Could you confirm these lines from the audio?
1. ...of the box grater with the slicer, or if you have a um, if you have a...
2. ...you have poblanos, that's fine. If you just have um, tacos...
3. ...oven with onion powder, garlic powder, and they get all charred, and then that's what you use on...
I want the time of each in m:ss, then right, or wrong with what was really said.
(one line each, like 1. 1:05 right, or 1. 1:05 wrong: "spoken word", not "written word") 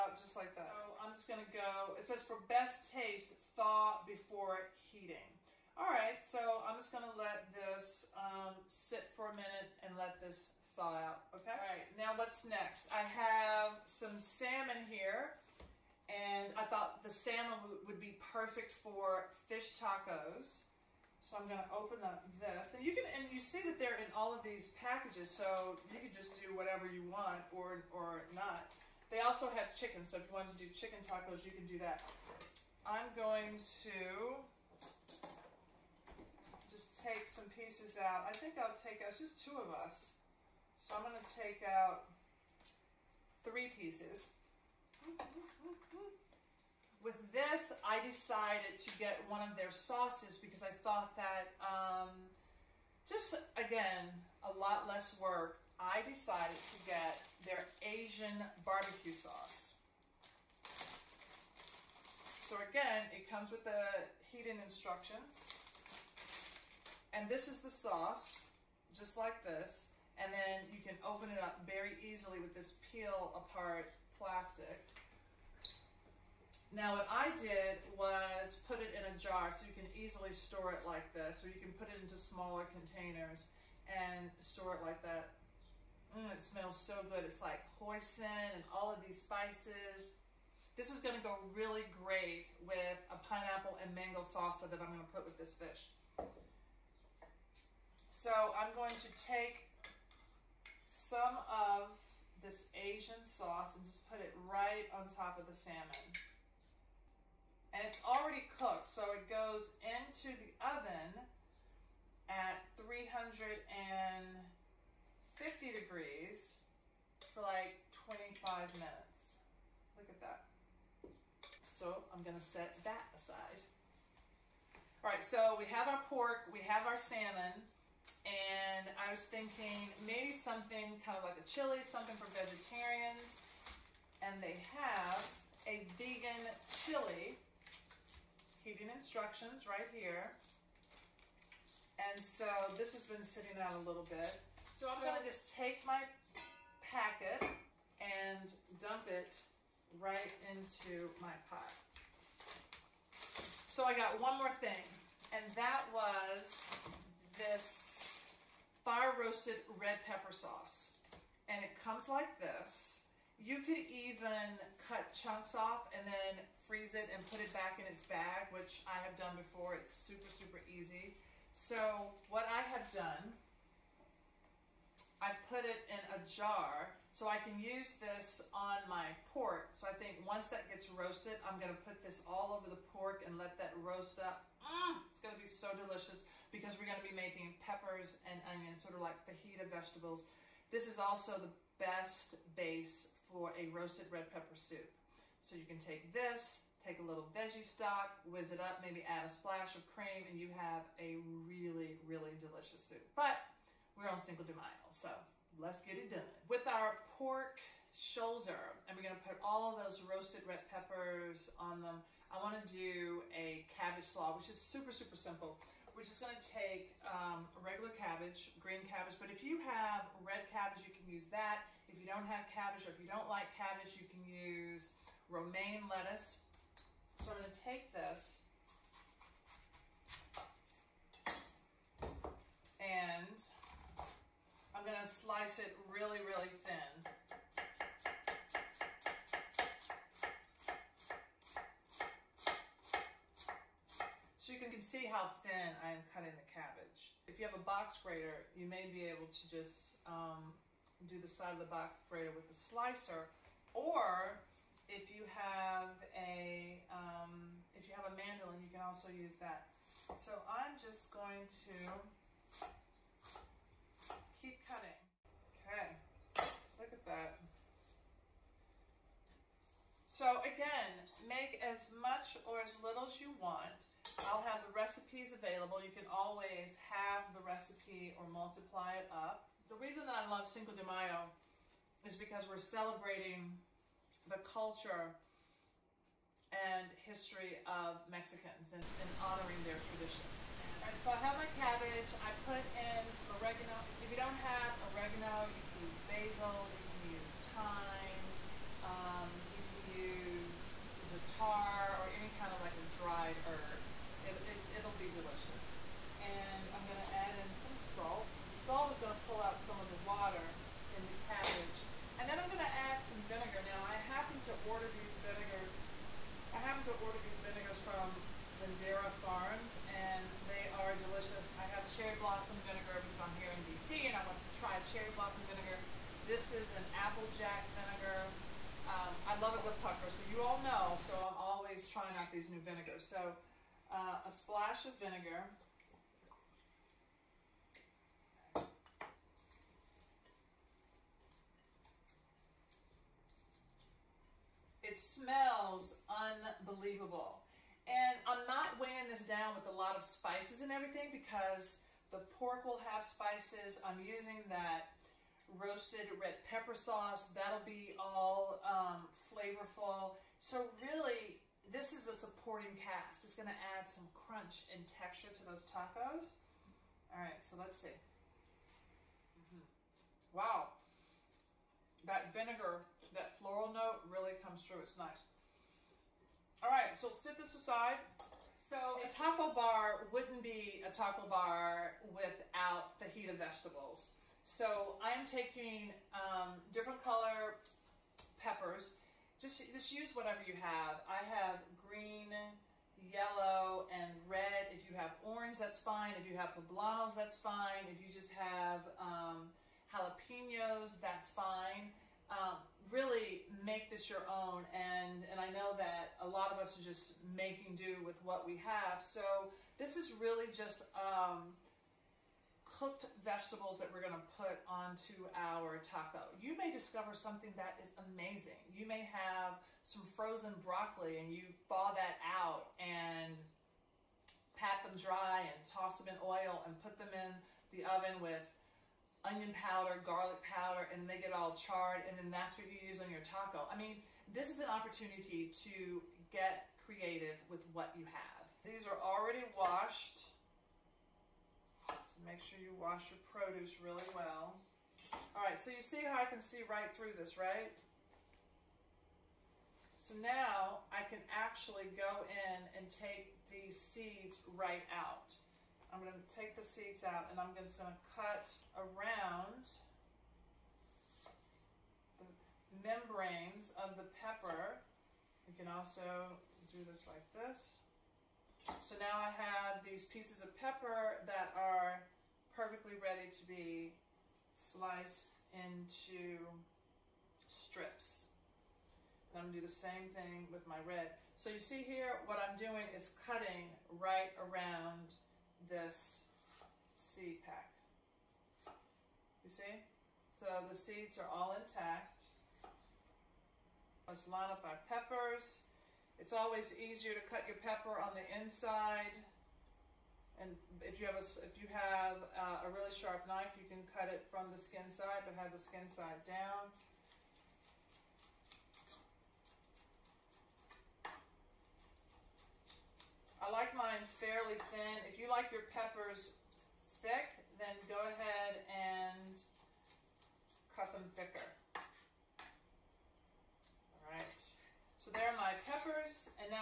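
1. 4:11 right
2. 6:36 wrong: "jalapenos", not "tacos"
3. 7:07 right.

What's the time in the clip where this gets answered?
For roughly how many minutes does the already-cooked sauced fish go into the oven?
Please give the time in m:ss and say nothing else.
1:58.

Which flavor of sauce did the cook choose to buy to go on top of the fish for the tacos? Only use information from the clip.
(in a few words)
Asian barbecue.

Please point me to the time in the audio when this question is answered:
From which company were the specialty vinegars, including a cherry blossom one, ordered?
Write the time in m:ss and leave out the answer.
5:18.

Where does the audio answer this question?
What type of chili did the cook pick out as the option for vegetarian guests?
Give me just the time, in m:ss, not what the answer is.
2:15.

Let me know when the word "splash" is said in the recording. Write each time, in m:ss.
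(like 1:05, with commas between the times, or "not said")
3:19, 5:34.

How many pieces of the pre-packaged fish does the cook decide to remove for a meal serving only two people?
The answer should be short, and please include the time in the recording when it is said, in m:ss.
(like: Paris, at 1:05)
3, at 0:43.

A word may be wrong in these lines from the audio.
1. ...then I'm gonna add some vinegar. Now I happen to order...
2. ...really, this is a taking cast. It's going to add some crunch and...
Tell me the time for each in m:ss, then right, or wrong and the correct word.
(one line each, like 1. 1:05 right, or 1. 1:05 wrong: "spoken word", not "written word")
1. 5:12 right
2. 6:00 wrong: "supporting", not "taking".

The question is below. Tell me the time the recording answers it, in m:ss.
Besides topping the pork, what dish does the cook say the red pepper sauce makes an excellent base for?
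3:13.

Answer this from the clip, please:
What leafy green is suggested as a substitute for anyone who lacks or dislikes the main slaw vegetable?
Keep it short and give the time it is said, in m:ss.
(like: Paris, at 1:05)
romaine lettuce, at 3:45.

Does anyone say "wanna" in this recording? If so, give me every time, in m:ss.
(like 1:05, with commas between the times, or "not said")
3:32.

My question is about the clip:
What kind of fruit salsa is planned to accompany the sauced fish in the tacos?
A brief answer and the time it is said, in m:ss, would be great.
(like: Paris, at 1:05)
pineapple and mango, at 1:33.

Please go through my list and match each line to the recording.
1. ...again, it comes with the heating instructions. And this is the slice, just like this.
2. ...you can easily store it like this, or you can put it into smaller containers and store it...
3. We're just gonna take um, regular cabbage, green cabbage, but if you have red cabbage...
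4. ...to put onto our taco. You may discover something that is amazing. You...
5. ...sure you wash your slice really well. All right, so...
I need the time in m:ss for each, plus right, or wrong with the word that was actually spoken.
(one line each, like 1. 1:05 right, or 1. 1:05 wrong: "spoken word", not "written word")
1. 1:02 wrong: "sauce", not "slice"
2. 1:19 right
3. 3:35 right
4. 6:54 right
5. 7:22 wrong: "produce", not "slice".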